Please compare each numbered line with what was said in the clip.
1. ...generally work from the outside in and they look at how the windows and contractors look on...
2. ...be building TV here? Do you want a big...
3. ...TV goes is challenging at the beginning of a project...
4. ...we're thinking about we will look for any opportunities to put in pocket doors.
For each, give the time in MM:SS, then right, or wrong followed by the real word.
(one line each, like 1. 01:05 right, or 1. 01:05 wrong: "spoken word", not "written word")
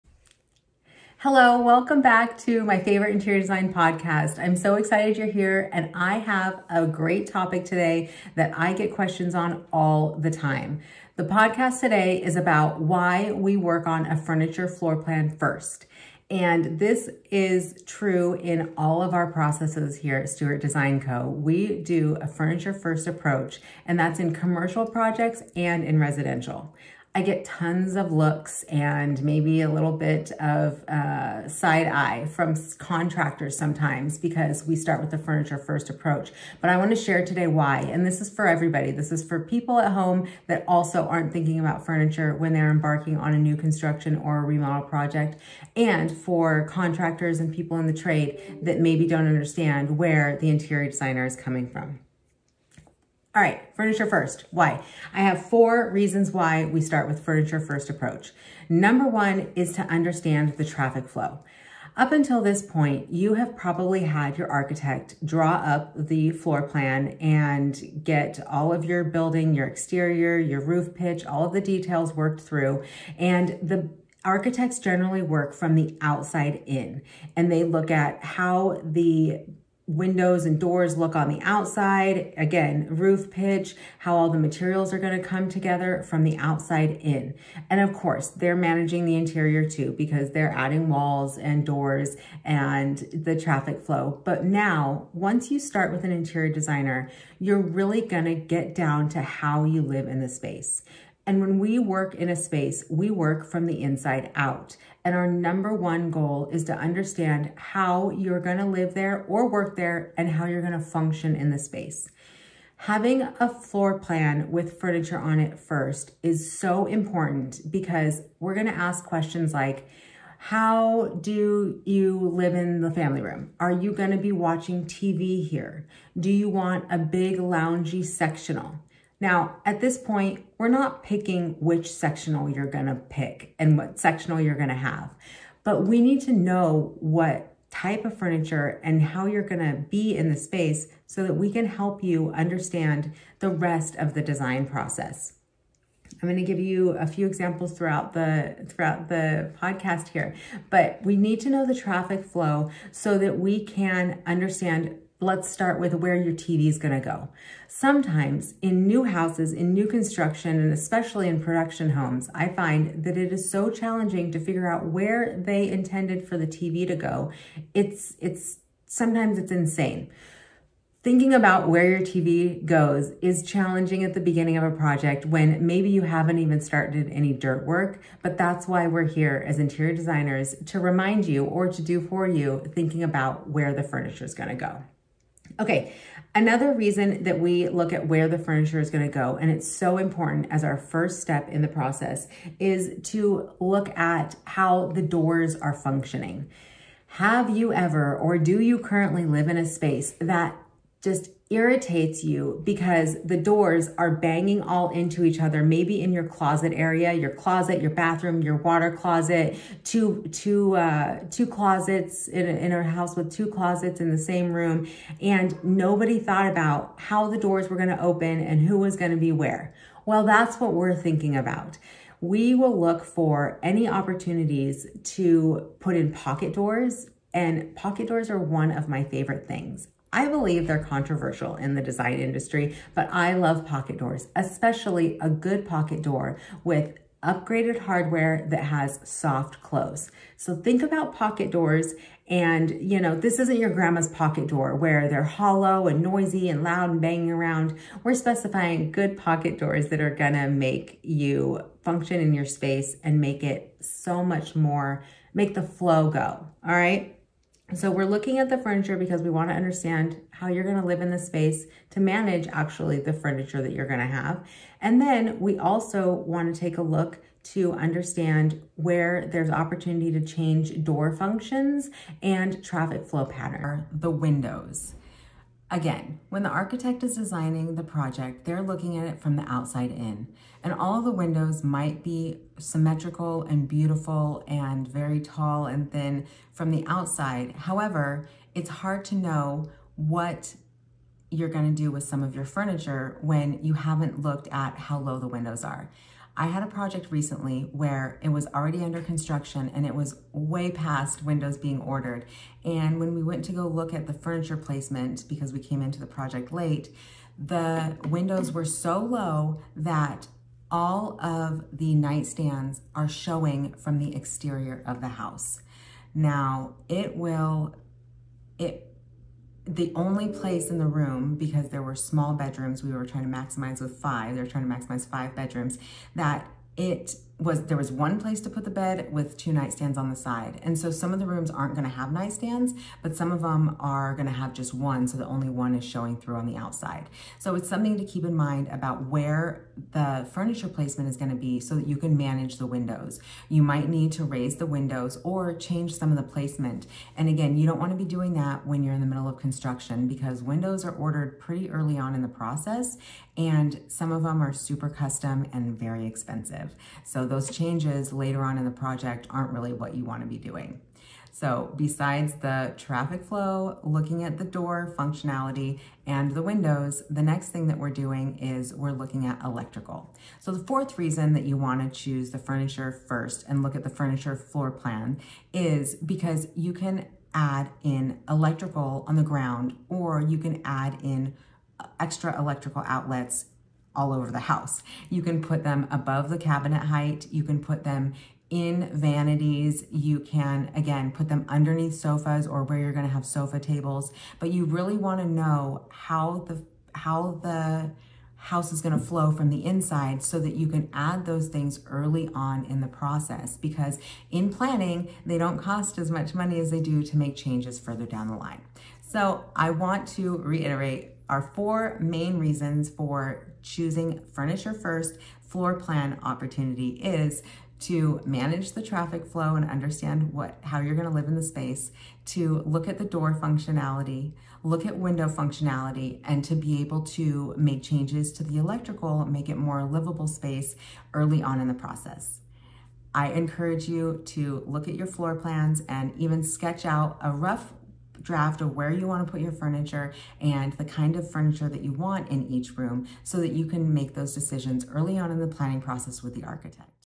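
1. 01:14 wrong: "doors", not "contractors"
2. 02:04 wrong: "watching", not "building"
3. 02:52 right
4. 03:40 right.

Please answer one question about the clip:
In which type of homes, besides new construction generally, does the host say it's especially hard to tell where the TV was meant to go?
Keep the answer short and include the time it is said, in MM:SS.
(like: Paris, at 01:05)
production homes, at 02:41.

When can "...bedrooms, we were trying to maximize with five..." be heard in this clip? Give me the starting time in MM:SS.
05:22.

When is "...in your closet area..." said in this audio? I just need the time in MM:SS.
03:26.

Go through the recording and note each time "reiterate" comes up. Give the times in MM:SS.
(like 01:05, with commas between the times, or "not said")
06:50.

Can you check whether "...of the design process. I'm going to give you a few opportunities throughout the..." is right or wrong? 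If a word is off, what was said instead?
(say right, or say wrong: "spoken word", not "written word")
wrong: "examples", not "opportunities".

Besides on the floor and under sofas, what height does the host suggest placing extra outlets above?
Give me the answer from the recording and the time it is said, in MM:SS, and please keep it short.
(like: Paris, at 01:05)
cabinet height, at 06:25.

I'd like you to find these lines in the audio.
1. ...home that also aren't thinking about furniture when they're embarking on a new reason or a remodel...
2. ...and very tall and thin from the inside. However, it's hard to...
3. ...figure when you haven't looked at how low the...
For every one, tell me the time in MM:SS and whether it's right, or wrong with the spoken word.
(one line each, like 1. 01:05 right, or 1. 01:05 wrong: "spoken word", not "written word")
1. 00:39 wrong: "construction", not "reason"
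2. 04:44 wrong: "outside", not "inside"
3. 04:52 wrong: "furniture", not "figure".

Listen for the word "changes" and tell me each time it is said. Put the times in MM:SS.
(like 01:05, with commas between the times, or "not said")
04:30, 05:45, 05:57, 06:47, 07:07.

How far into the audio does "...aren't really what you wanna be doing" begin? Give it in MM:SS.
05:59.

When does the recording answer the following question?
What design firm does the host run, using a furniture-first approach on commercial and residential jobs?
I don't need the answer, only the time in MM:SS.
00:20.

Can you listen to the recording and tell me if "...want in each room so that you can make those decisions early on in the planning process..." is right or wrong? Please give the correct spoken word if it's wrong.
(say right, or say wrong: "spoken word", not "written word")
right.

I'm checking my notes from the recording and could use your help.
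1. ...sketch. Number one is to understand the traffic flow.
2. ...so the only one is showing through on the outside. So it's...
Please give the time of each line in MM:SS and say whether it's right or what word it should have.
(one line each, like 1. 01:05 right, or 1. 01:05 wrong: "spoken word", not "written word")
1. 00:57 wrong: "approach", not "sketch"
2. 05:35 right.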